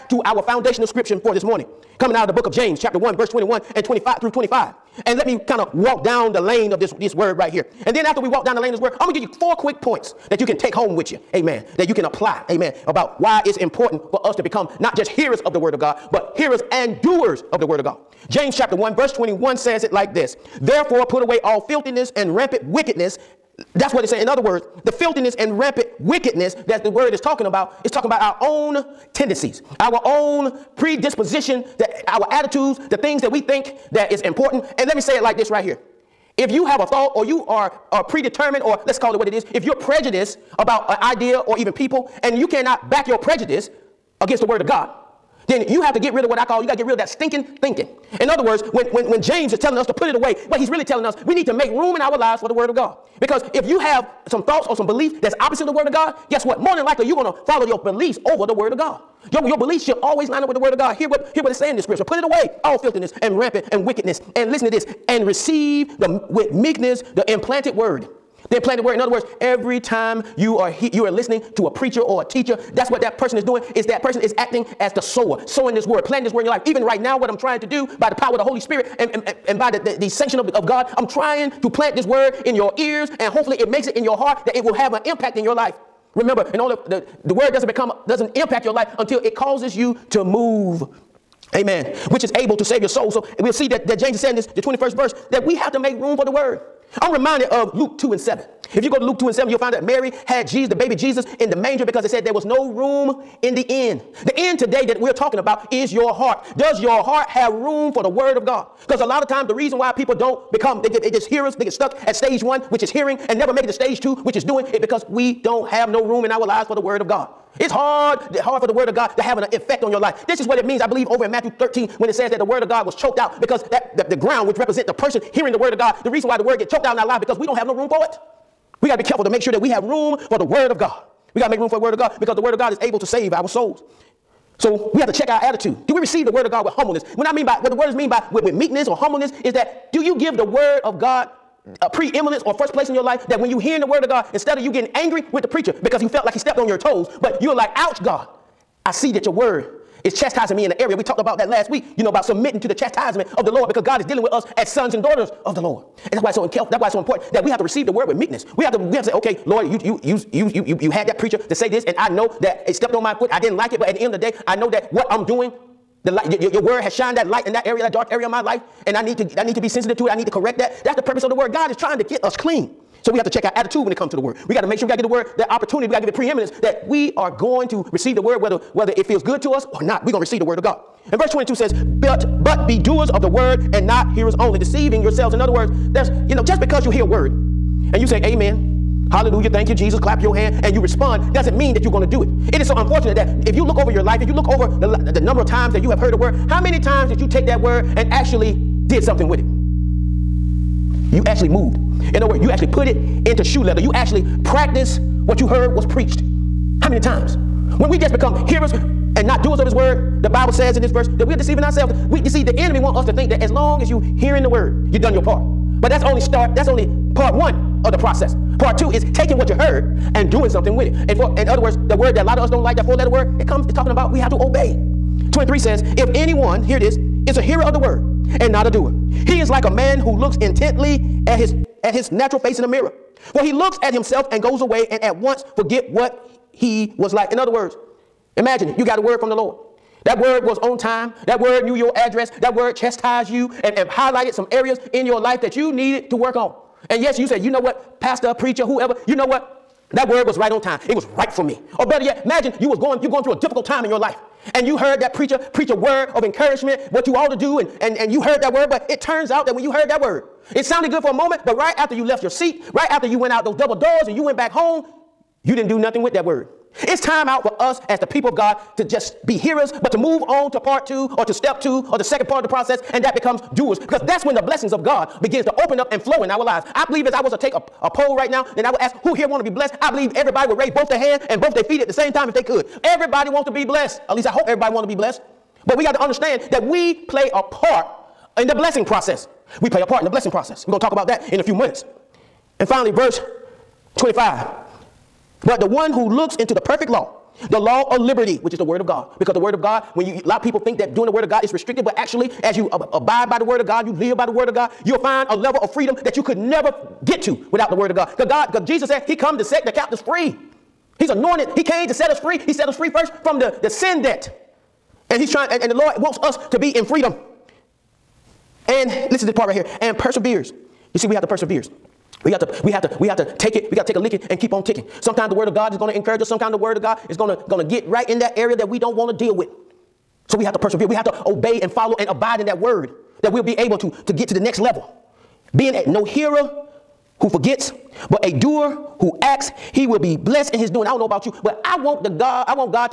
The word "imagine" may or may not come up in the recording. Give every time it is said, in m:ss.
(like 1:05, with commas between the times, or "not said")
3:58, 4:12.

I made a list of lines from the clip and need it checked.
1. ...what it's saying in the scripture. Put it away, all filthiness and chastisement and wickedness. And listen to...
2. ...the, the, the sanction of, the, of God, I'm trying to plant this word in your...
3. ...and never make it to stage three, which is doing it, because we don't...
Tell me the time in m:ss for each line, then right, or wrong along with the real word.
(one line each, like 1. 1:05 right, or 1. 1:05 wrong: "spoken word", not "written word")
1. 1:01 wrong: "rampant", not "chastisement"
2. 1:19 right
3. 1:53 wrong: "two", not "three".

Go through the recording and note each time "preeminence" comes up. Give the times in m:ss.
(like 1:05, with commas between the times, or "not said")
2:21, 2:56.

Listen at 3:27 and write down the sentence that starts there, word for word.
When we just become hearers and not doers of his word, the Bible says in this verse that we're deceiving ourselves.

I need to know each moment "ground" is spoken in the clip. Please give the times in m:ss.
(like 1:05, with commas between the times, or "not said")
2:04.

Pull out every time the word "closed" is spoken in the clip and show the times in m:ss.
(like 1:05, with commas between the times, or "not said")
not said.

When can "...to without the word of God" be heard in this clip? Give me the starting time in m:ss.
5:07.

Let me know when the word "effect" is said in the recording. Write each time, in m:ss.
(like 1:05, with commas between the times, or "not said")
1:59.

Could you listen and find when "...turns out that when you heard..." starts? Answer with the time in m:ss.
4:19.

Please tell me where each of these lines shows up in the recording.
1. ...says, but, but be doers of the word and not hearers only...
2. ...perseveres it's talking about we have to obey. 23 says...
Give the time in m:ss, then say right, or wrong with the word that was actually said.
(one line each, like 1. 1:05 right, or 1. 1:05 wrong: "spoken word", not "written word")
1. 3:01 right
2. 3:43 wrong: "comes", not "perseveres".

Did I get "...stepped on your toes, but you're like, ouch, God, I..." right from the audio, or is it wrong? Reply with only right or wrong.
right.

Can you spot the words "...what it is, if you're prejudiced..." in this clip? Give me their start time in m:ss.
0:39.